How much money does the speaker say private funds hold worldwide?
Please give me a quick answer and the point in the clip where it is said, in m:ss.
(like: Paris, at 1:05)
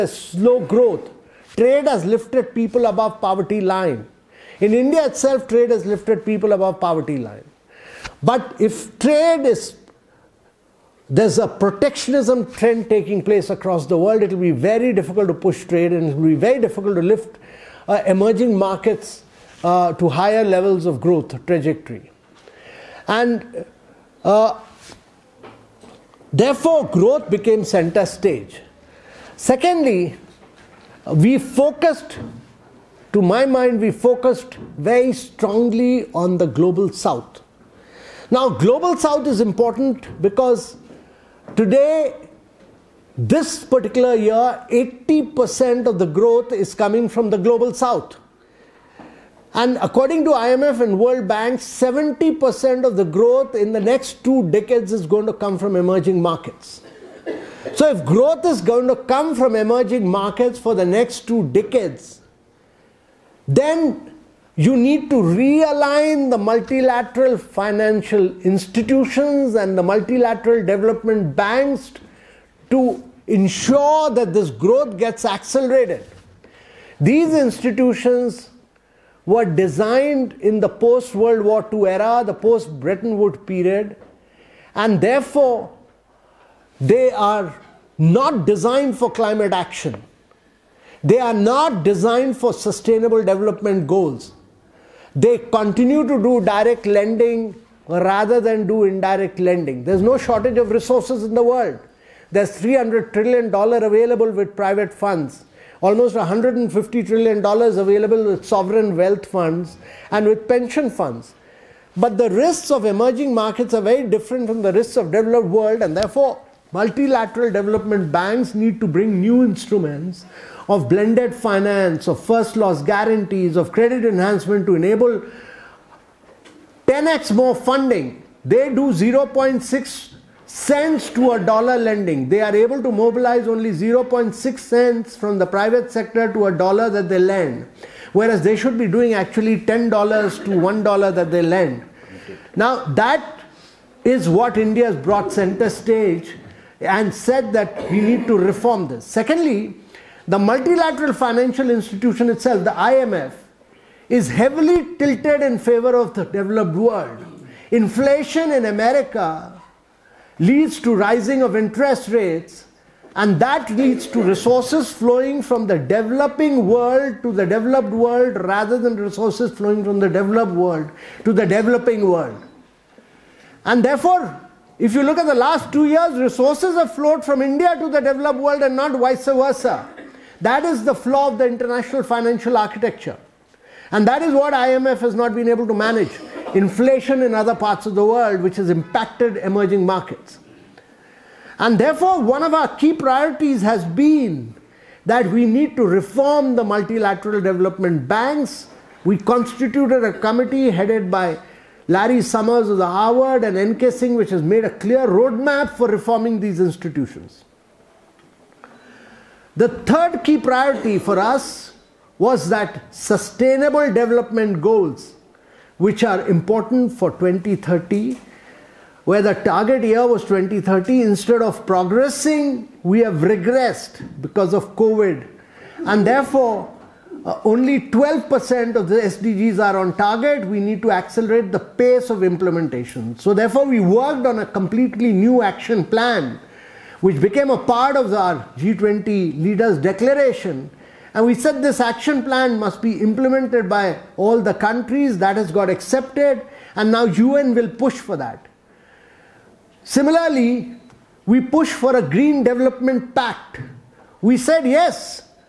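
$300 trillion, at 1:42.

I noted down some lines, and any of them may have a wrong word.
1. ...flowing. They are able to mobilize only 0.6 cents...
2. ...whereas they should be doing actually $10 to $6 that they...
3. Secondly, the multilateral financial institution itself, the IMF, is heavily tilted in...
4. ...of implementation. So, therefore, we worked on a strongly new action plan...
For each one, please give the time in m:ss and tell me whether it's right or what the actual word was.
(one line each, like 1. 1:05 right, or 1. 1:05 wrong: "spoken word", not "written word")
1. 2:11 wrong: "lending", not "flowing"
2. 2:18 wrong: "1", not "6"
3. 2:29 right
4. 3:52 wrong: "completely", not "strongly".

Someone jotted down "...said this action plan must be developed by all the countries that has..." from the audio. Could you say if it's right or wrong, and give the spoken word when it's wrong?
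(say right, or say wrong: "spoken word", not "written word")
wrong: "implemented", not "developed".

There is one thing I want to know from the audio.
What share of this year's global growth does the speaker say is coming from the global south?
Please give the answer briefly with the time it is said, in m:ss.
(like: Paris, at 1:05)
80%, at 0:44.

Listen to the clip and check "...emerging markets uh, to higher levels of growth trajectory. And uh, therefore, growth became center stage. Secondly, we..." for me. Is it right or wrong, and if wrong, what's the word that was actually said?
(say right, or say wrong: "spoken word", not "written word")
right.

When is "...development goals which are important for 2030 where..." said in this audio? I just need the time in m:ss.
3:33.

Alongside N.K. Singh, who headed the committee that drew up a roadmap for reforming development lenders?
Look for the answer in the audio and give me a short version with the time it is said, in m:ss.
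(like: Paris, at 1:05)
Larry Summers, at 3:21.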